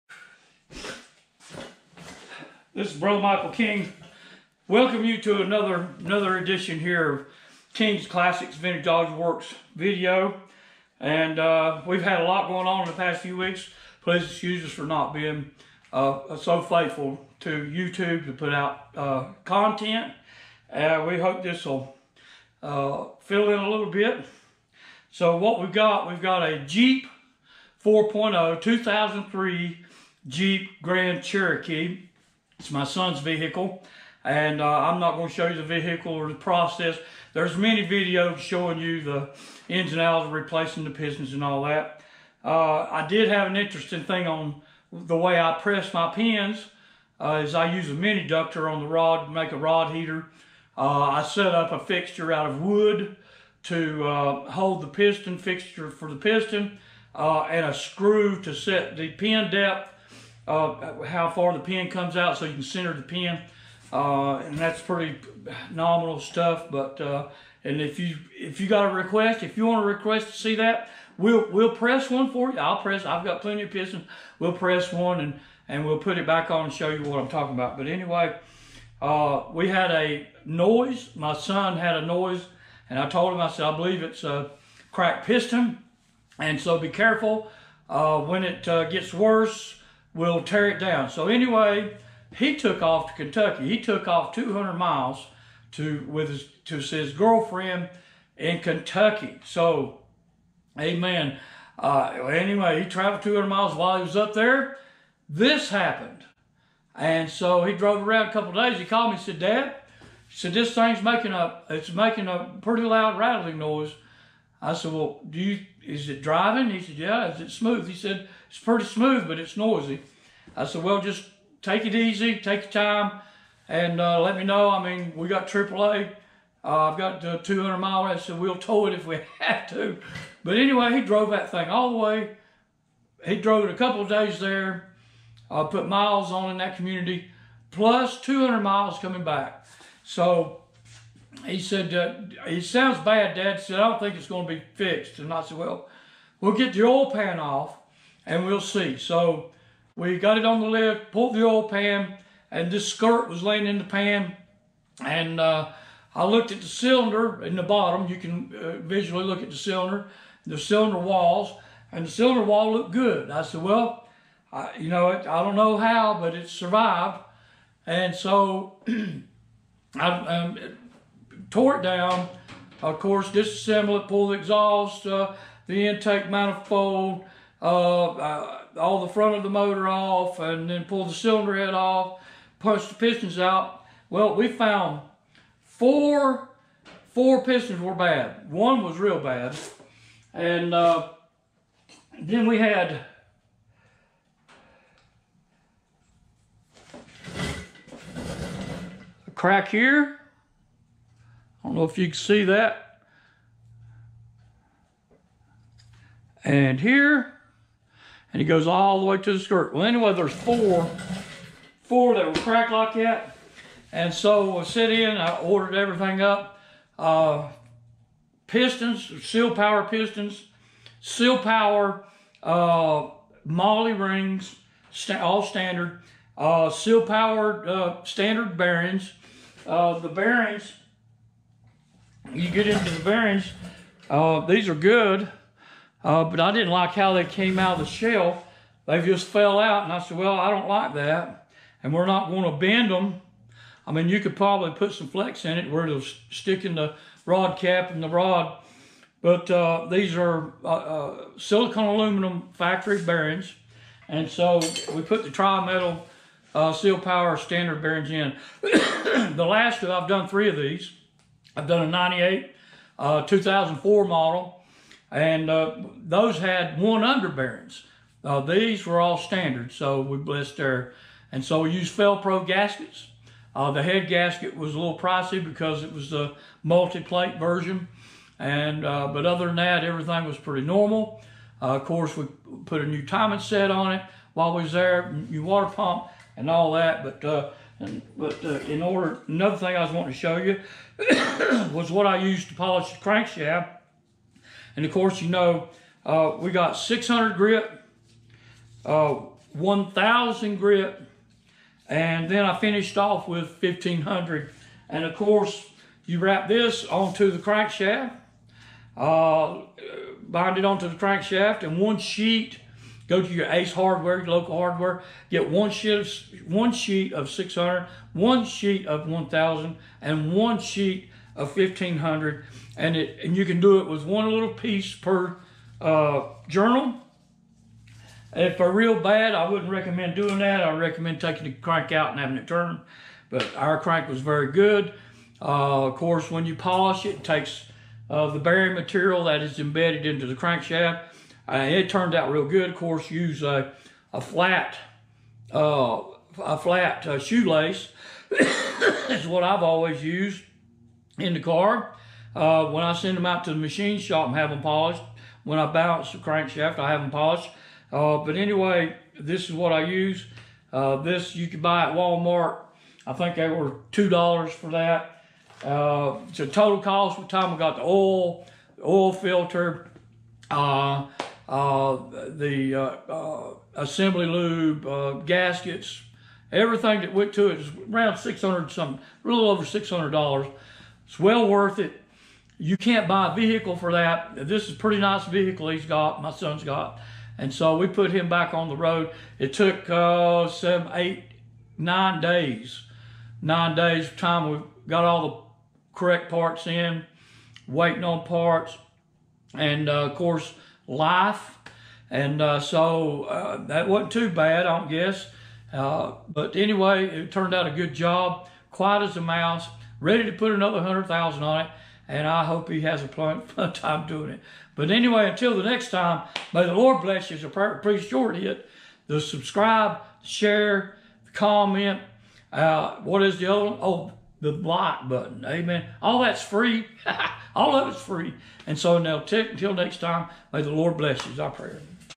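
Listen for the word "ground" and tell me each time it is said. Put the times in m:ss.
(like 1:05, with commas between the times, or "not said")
not said.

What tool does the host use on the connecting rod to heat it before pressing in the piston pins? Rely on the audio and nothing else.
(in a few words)
mini ductor.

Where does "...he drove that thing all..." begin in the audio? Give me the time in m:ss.
2:10.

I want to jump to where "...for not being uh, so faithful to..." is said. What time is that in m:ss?
0:14.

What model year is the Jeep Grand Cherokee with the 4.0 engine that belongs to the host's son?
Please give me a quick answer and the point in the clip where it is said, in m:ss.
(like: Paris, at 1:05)
2003, at 0:28.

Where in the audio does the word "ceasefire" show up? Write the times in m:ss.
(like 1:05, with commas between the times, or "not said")
not said.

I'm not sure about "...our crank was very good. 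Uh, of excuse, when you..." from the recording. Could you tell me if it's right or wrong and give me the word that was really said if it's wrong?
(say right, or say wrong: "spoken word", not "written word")
wrong: "course", not "excuse".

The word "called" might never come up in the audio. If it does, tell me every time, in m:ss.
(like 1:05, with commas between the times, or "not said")
1:48.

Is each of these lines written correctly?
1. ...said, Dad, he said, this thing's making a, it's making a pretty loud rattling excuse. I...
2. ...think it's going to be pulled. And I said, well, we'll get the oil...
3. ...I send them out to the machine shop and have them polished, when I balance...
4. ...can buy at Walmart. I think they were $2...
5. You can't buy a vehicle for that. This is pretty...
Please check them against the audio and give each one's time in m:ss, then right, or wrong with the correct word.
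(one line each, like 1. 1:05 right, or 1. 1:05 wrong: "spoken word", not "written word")
1. 1:49 wrong: "noise", not "excuse"
2. 2:23 wrong: "fixed", not "pulled"
3. 5:52 right
4. 6:01 right
5. 6:22 right.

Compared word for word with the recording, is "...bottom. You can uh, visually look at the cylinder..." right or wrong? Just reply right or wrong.
right.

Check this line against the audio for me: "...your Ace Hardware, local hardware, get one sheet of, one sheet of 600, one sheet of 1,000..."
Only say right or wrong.
right.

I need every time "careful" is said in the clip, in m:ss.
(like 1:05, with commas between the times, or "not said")
1:26.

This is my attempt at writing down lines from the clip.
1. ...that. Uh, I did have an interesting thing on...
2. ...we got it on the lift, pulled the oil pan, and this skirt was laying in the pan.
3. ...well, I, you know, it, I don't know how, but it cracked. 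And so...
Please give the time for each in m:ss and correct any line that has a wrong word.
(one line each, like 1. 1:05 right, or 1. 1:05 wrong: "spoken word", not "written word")
1. 0:41 right
2. 2:29 right
3. 2:43 wrong: "survived", not "cracked".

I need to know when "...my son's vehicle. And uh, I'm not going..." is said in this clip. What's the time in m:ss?
0:32.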